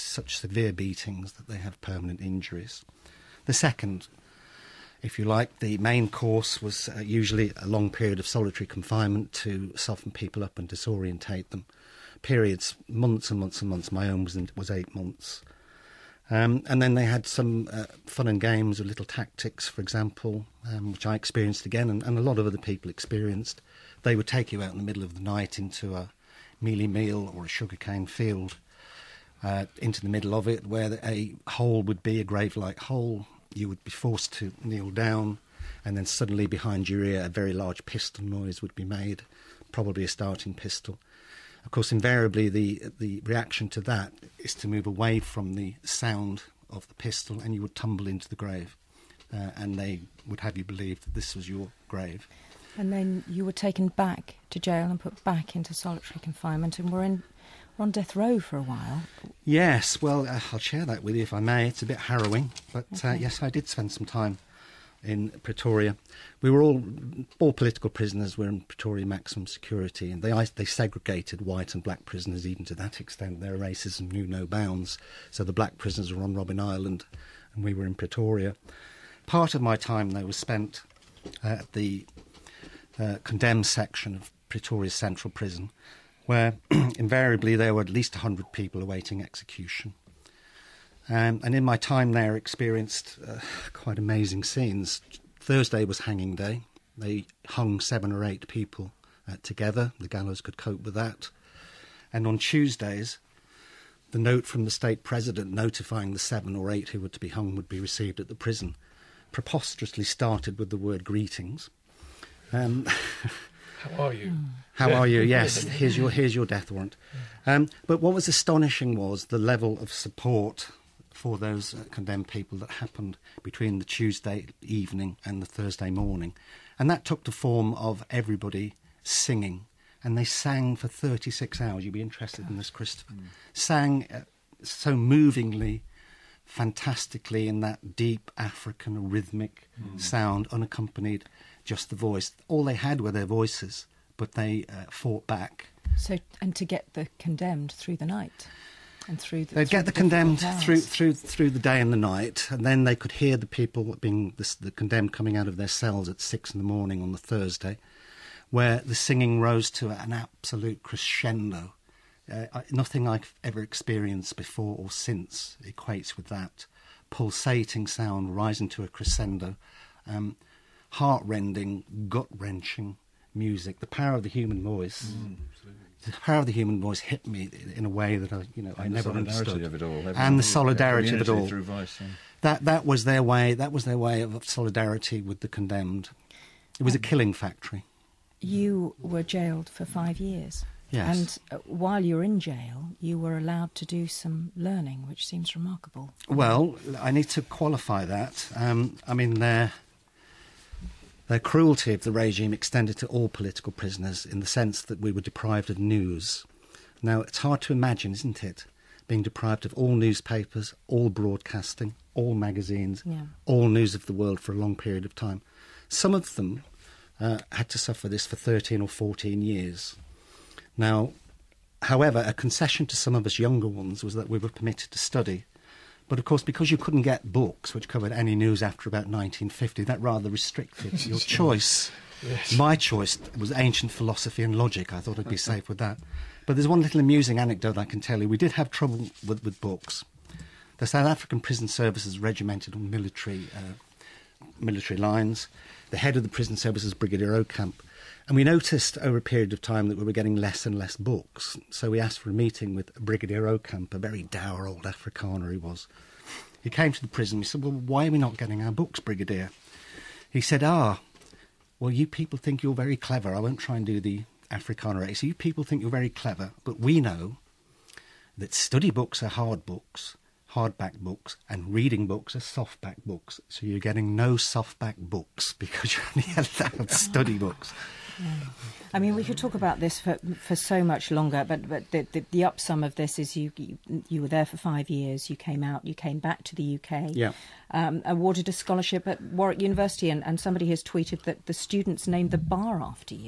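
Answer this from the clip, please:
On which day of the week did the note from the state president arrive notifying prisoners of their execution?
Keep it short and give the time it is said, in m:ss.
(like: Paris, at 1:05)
Tuesday, at 1:42.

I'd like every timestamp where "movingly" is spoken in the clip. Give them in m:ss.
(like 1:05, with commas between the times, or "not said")
2:14.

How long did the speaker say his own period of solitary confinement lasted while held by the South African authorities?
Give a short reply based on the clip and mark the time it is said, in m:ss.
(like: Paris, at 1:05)
8 months, at 0:14.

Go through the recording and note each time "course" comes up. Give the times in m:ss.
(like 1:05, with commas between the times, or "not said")
0:06, 0:41, 3:46.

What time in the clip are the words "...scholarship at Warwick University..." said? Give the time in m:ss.
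4:48.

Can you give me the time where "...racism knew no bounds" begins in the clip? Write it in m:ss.
1:13.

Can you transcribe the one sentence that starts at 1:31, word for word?
Um, and in my time there, experienced uh, quite amazing scenes.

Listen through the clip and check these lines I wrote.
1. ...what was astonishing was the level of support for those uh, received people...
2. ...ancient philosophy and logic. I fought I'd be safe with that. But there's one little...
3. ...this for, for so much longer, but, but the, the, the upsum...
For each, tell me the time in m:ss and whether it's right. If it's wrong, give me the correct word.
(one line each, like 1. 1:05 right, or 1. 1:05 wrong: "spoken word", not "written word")
1. 1:58 wrong: "condemned", not "received"
2. 3:53 wrong: "thought", not "fought"
3. 4:39 right.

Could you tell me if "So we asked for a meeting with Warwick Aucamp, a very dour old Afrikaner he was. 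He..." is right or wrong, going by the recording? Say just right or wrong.
wrong.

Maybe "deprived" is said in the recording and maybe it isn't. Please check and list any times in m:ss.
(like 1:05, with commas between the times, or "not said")
3:25, 3:29.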